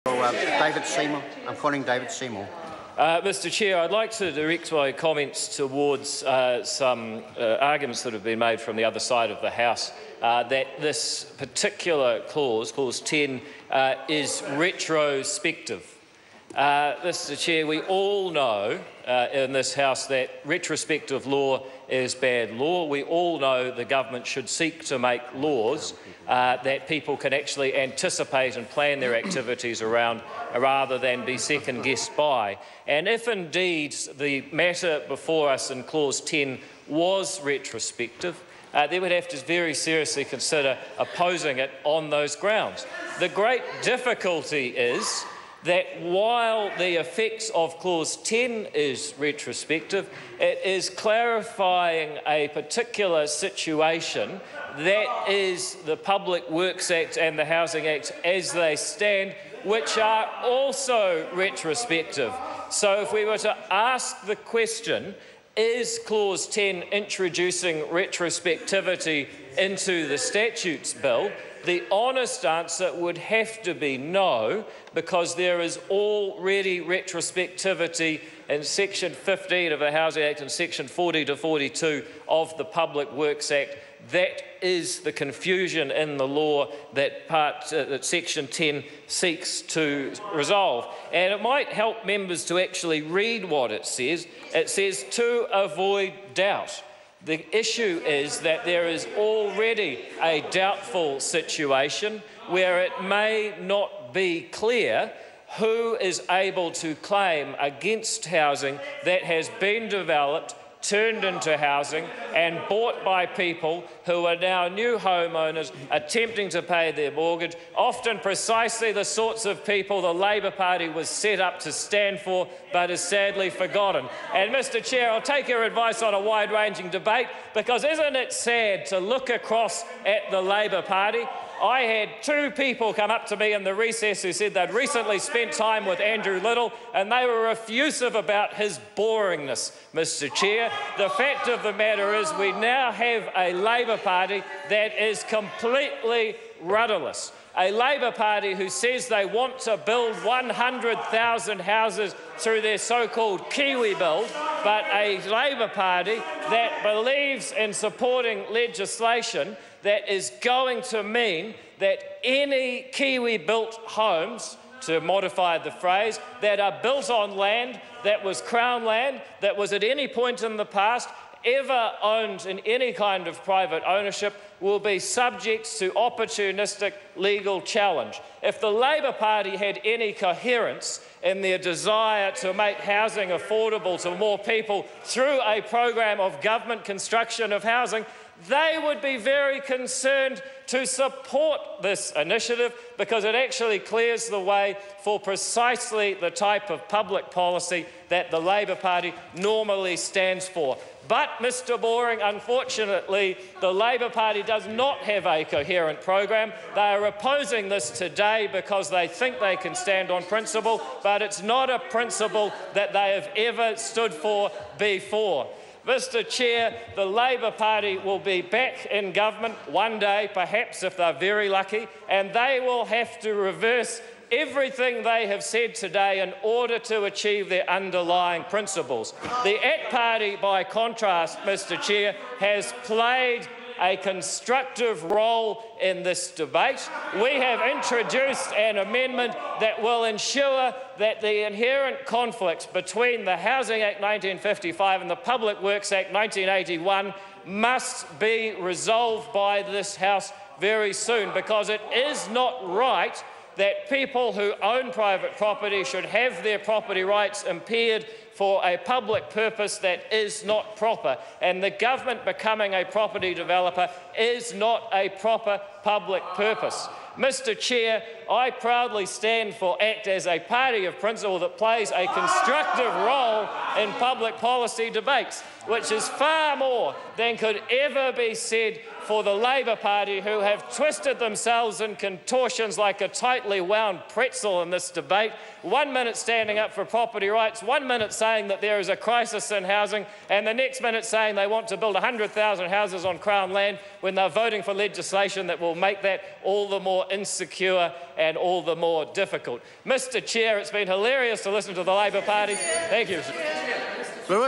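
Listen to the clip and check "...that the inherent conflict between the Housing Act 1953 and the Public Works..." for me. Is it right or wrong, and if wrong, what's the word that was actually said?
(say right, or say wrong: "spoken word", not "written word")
wrong: "1955", not "1953".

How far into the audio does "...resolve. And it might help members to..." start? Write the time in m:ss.
1:30.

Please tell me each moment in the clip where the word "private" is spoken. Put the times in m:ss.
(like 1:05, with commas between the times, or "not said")
2:53, 4:14.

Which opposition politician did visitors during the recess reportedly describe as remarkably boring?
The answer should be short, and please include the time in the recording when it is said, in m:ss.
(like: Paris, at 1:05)
Andrew Little, at 2:15.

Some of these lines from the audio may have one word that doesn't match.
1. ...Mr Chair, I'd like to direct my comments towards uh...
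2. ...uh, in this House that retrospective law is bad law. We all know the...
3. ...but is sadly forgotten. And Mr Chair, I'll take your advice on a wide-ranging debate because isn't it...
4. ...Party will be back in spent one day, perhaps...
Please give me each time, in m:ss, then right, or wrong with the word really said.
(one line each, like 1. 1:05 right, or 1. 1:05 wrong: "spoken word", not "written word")
1. 0:03 right
2. 0:19 right
3. 2:02 right
4. 3:37 wrong: "government", not "spent".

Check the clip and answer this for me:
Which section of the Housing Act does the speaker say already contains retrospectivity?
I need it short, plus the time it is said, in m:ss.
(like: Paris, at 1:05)
Section 15, at 1:18.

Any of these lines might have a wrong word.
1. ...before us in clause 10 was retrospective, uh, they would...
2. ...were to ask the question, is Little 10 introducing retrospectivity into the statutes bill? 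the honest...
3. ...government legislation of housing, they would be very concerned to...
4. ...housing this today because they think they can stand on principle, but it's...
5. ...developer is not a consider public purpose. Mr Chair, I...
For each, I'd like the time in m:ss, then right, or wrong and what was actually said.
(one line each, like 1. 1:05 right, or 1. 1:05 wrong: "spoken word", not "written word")
1. 0:35 right
2. 1:03 wrong: "Clause", not "Little"
3. 3:06 wrong: "construction", not "legislation"
4. 3:27 wrong: "opposing", not "housing"
5. 4:23 wrong: "proper", not "consider".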